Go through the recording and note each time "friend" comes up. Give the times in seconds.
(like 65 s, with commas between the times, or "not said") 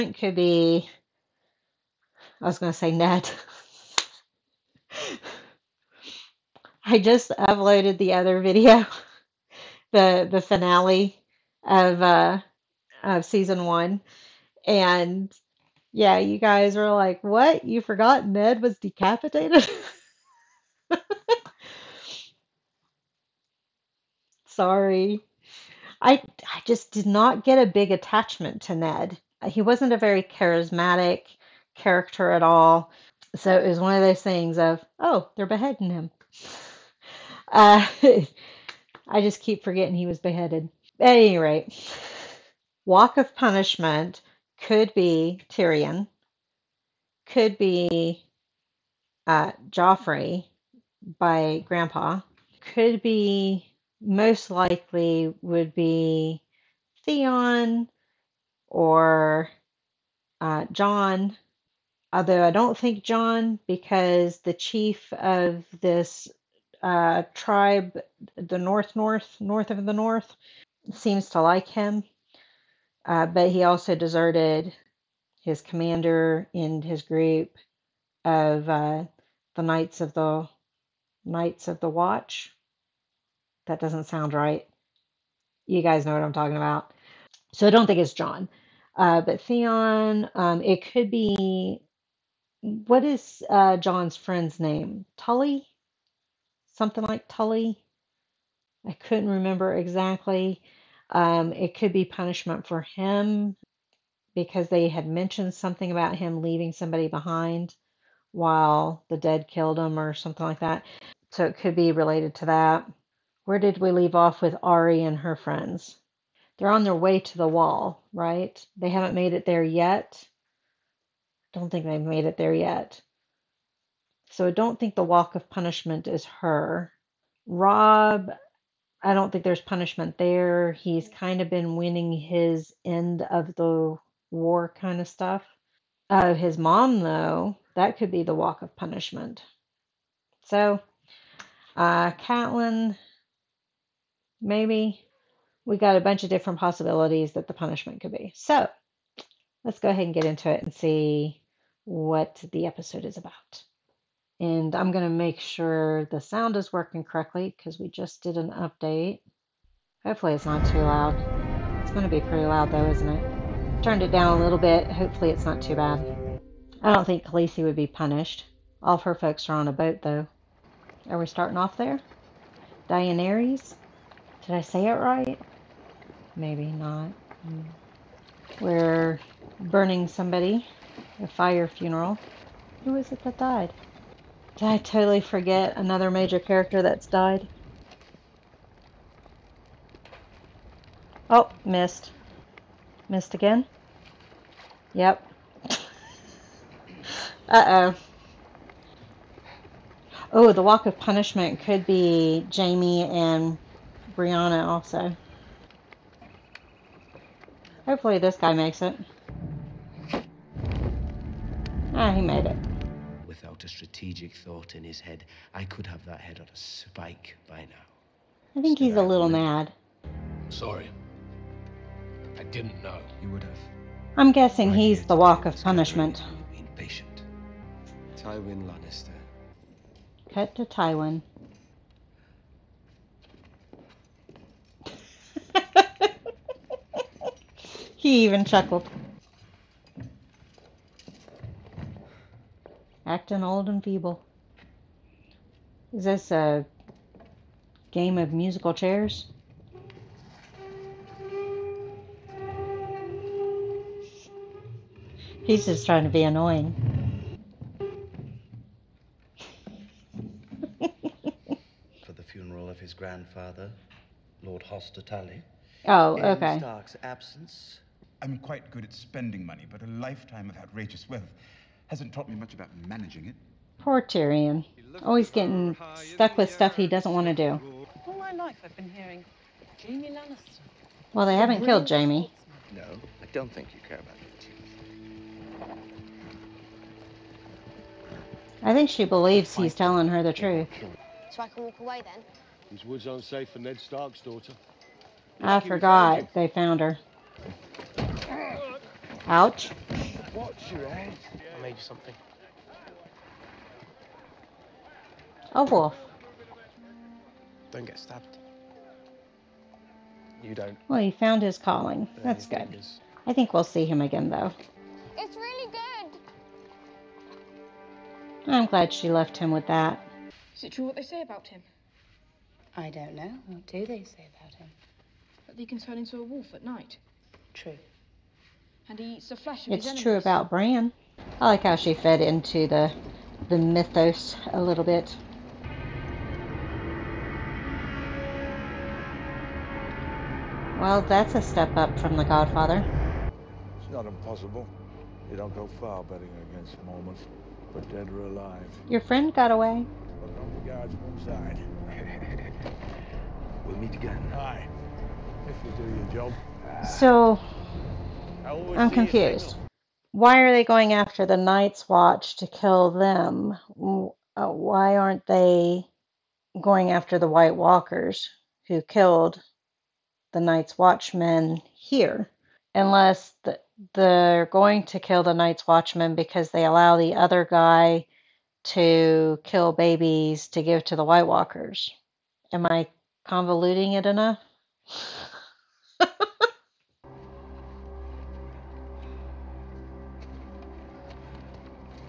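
94 s, 115 s, 349 s.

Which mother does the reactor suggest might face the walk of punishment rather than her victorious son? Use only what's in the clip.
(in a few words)
Catelyn.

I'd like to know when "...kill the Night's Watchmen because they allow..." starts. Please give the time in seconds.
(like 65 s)
374 s.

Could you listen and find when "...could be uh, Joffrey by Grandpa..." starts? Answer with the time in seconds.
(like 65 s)
47 s.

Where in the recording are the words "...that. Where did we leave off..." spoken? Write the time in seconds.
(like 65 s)
112 s.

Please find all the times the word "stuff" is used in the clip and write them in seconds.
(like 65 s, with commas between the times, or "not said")
135 s, 276 s.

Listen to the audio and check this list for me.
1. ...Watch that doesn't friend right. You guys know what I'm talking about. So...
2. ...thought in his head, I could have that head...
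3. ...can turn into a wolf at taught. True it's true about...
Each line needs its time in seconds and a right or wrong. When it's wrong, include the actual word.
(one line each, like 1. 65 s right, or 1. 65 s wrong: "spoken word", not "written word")
1. 81 s wrong: "sound", not "friend"
2. 214 s right
3. 325 s wrong: "night", not "taught".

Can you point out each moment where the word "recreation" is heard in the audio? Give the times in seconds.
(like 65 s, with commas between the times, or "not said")
not said.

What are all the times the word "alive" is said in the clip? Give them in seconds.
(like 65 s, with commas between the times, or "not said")
348 s.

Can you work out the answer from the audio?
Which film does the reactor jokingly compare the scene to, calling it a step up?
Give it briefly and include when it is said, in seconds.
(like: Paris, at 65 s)
The Godfather, at 342 s.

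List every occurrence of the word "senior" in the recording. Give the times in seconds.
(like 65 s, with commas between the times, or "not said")
not said.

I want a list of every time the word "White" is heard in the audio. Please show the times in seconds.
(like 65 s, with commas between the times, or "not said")
367 s, 381 s.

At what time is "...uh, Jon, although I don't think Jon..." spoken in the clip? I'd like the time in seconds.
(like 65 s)
60 s.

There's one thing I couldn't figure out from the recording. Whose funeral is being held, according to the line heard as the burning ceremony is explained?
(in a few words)
Lord Hoster.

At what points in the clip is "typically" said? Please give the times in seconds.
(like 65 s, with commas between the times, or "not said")
not said.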